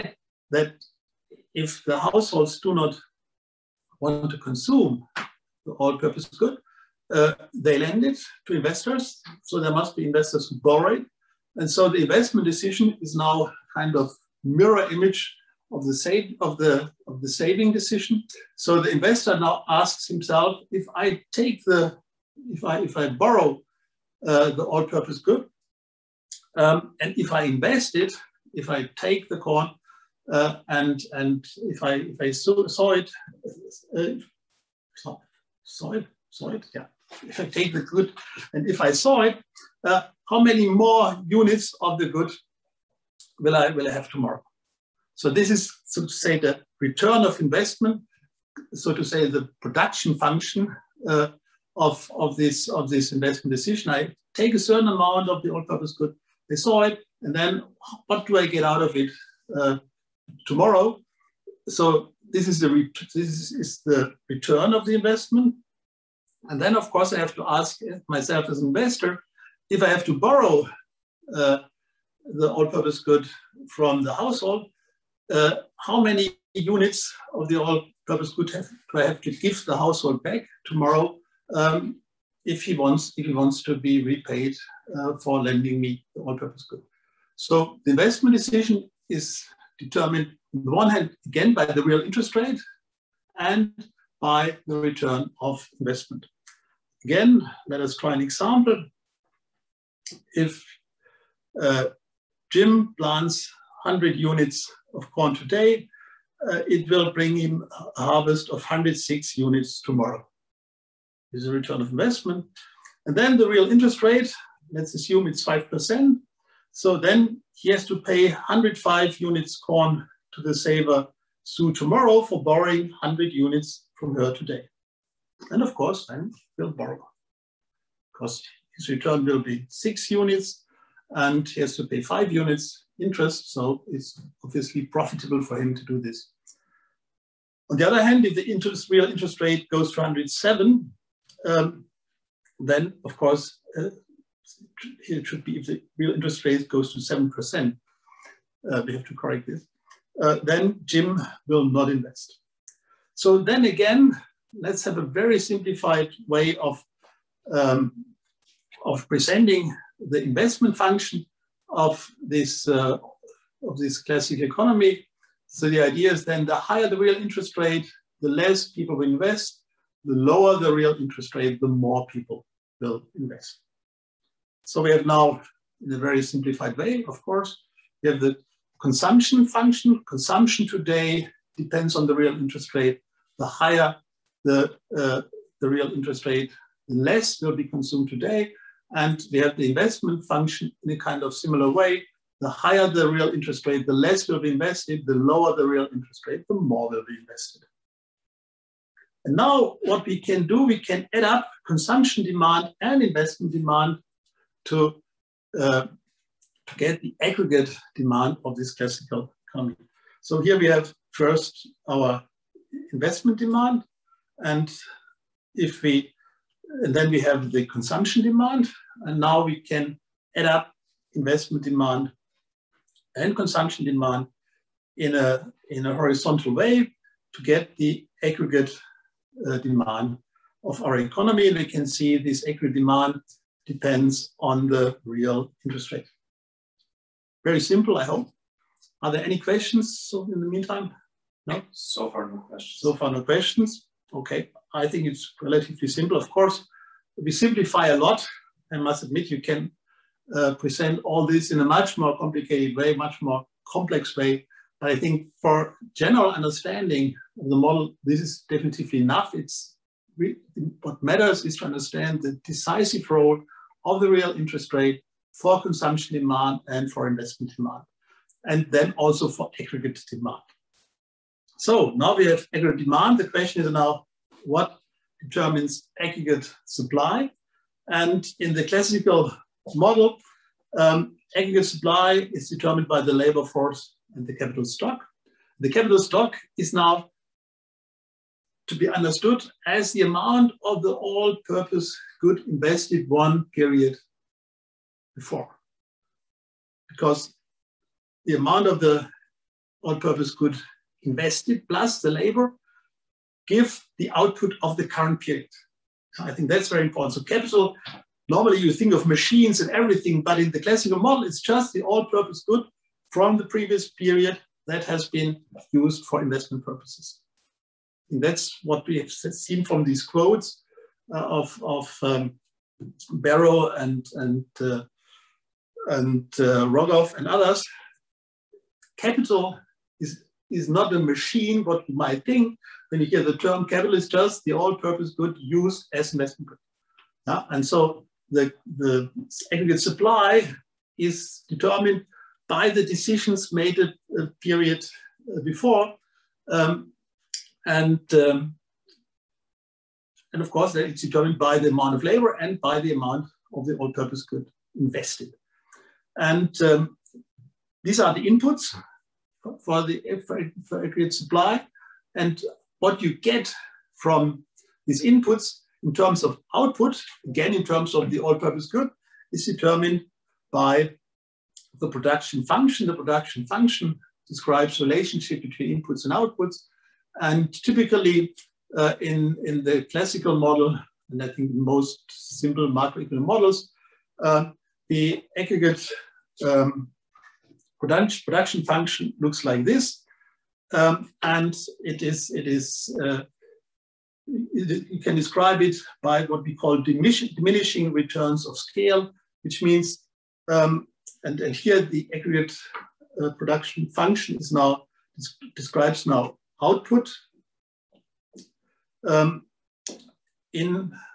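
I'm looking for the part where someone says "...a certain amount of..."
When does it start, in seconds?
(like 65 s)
54 s.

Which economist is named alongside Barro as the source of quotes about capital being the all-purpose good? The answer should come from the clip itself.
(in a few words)
Rogoff.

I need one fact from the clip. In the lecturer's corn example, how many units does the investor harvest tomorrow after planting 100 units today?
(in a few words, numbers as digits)
106.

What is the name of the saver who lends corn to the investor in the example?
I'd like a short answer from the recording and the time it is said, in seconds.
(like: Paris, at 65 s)
Sue, at 121 s.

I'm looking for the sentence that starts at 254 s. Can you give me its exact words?
But I think for general understanding of the model, this is definitely enough.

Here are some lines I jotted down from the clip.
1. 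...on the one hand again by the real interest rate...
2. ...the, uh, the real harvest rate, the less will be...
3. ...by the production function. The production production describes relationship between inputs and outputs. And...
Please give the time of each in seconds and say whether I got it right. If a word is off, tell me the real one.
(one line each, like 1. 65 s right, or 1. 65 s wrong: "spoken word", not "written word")
1. 90 s right
2. 184 s wrong: "interest", not "harvest"
3. 370 s wrong: "function", not "production".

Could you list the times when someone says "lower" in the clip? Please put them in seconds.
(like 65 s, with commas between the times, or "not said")
170 s, 195 s.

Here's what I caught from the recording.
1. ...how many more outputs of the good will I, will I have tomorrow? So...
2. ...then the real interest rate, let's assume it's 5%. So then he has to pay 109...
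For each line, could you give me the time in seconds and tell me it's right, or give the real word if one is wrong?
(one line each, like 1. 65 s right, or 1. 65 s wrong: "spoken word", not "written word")
1. 40 s wrong: "units", not "outputs"
2. 113 s wrong: "105", not "109".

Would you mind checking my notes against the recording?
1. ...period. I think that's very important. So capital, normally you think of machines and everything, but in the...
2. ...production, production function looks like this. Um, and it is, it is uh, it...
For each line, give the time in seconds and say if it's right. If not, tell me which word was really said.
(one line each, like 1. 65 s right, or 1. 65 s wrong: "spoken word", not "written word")
1. 305 s right
2. 387 s right.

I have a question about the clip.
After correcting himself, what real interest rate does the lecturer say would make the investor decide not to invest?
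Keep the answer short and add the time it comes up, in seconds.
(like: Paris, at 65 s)
7%, at 147 s.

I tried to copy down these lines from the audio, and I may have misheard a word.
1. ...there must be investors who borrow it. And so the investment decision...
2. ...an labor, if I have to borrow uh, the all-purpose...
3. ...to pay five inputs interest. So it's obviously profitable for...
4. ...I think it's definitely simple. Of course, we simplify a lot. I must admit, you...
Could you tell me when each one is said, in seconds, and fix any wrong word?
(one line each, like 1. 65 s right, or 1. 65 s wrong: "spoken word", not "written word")
1. 9 s right
2. 68 s wrong: "investor", not "labor"
3. 131 s wrong: "units", not "inputs"
4. 244 s wrong: "relatively", not "definitely".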